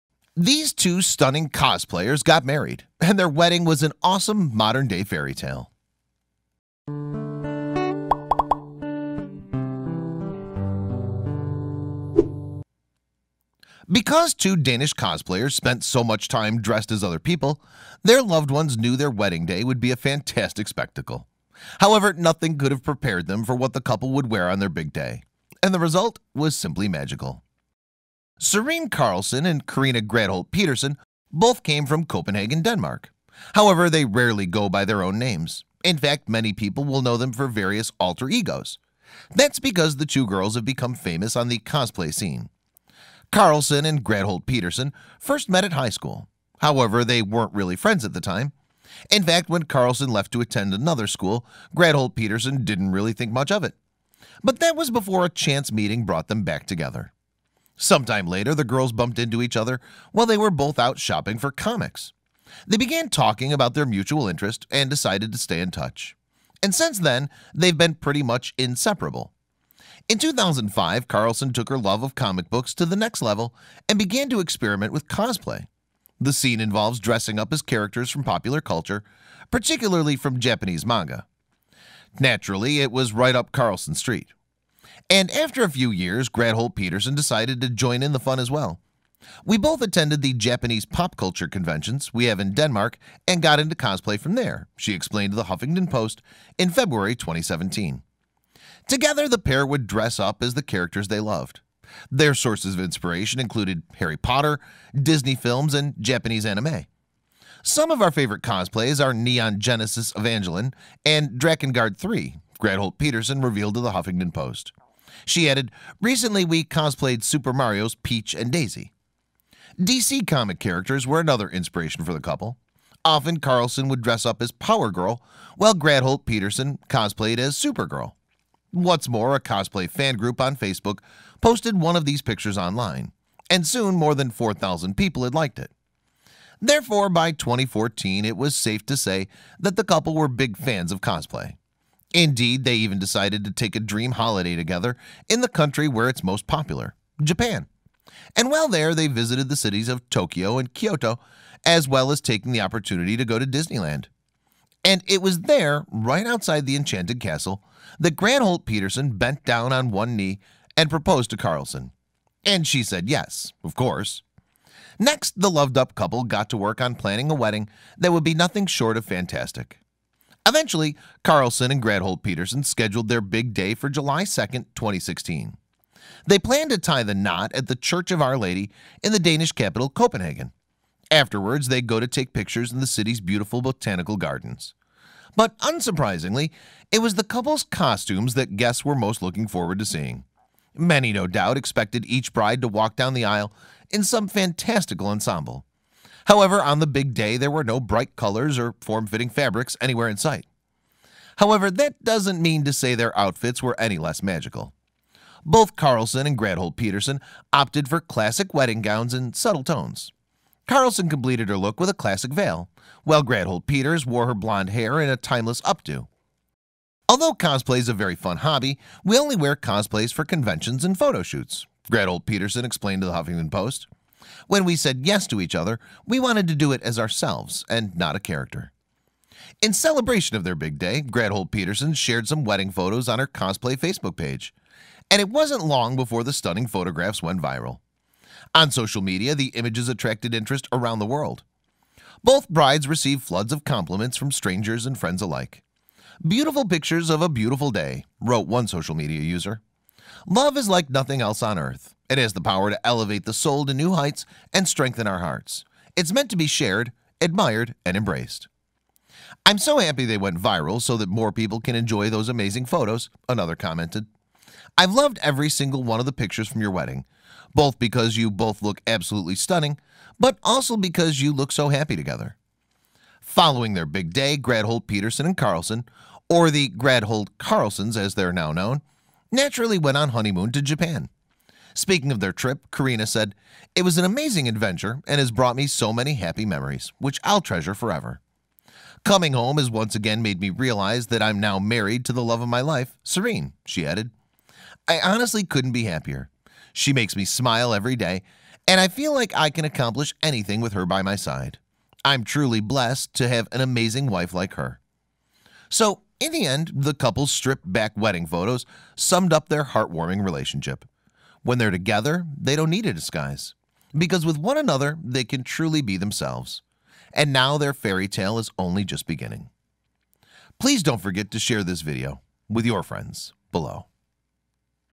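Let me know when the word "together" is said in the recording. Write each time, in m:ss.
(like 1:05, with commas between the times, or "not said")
0:56, 1:38, 2:24, 4:31, 5:11.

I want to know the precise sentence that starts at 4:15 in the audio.
It's meant to be shared, admired, and embraced.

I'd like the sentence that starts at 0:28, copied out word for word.
Serene Carlson and Karina Gredholt Peterson both came from Copenhagen, Denmark.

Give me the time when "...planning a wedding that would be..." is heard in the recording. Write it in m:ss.
2:46.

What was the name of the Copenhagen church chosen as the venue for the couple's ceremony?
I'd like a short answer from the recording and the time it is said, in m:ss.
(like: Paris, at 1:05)
Church of Our Lady, at 2:57.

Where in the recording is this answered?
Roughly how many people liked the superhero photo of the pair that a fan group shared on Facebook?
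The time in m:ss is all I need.
2:14.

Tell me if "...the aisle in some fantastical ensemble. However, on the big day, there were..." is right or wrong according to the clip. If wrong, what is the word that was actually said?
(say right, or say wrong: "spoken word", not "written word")
right.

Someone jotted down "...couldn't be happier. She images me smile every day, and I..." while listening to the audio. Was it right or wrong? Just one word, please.
wrong.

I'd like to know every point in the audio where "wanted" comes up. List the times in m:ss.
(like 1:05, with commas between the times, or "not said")
3:46.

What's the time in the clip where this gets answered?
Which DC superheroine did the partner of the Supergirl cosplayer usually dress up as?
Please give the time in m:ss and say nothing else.
2:04.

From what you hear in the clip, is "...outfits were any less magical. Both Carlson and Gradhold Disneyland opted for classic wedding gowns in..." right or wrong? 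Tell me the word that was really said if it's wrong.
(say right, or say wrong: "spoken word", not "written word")
wrong: "Peterson", not "Disneyland".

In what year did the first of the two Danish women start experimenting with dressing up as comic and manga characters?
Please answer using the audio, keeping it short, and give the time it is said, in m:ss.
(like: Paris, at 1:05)
2005, at 1:10.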